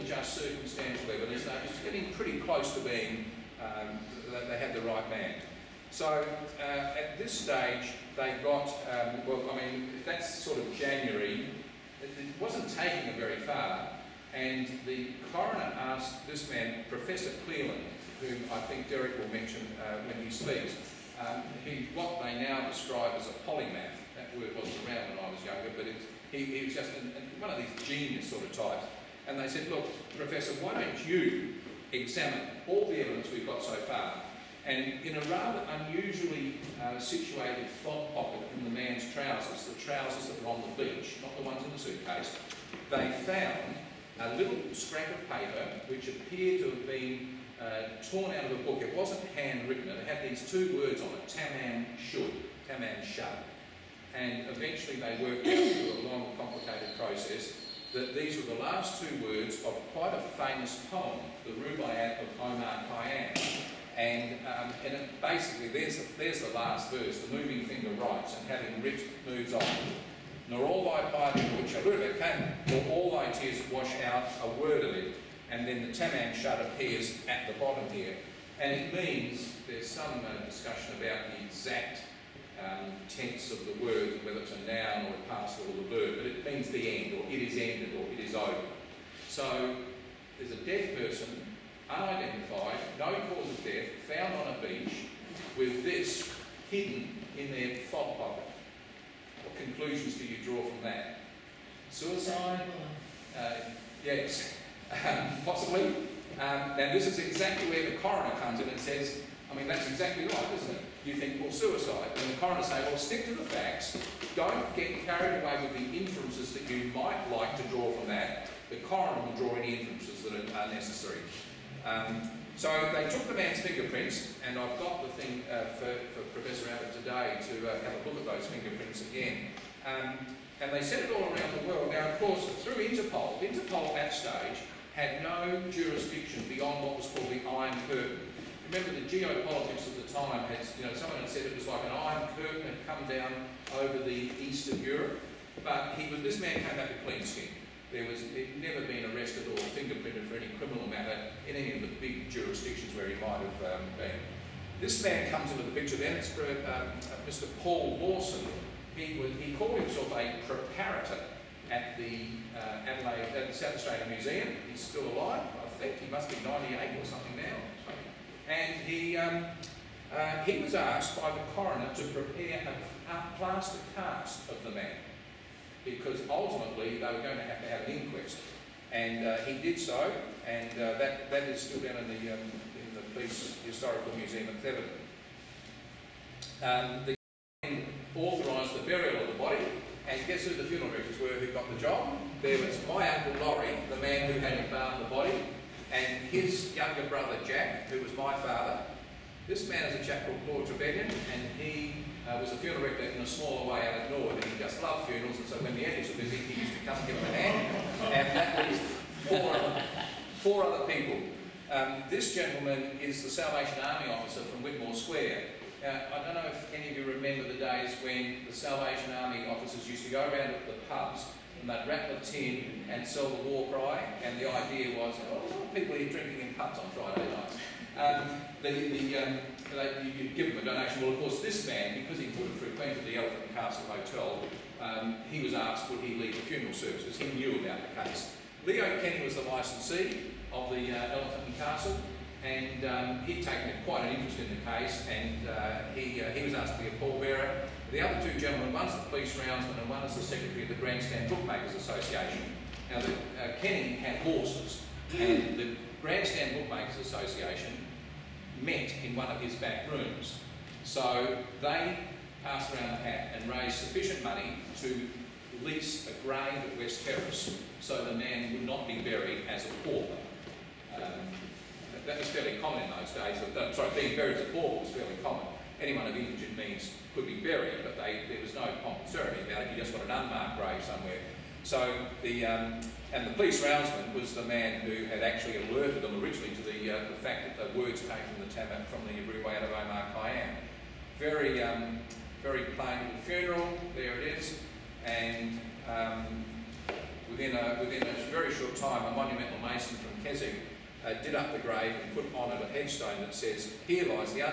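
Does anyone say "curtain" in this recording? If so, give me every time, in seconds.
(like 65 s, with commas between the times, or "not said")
137 s, 142 s.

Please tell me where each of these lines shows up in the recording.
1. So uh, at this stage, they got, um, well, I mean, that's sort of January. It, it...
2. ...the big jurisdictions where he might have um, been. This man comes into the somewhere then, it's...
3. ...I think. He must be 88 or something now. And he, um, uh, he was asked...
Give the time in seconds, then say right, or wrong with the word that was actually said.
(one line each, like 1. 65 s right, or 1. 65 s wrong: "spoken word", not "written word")
1. 5 s right
2. 151 s wrong: "picture", not "somewhere"
3. 165 s wrong: "98", not "88".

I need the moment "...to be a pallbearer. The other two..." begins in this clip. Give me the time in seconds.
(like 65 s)
246 s.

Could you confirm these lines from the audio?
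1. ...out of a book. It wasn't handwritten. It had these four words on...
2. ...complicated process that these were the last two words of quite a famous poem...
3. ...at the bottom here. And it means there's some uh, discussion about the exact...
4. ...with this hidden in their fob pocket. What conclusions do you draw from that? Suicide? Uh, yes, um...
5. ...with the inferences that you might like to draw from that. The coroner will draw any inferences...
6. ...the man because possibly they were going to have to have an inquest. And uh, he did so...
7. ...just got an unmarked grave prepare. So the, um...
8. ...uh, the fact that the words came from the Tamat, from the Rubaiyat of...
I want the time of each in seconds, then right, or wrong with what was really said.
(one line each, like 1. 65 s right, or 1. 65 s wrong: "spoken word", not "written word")
1. 48 s wrong: "two", not "four"
2. 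56 s right
3. 77 s right
4. 95 s right
5. 115 s right
6. 174 s wrong: "ultimately", not "possibly"
7. 279 s wrong: "somewhere", not "prepare"
8. 286 s right.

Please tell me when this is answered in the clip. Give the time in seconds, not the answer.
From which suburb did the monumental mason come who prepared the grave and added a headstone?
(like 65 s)
300 s.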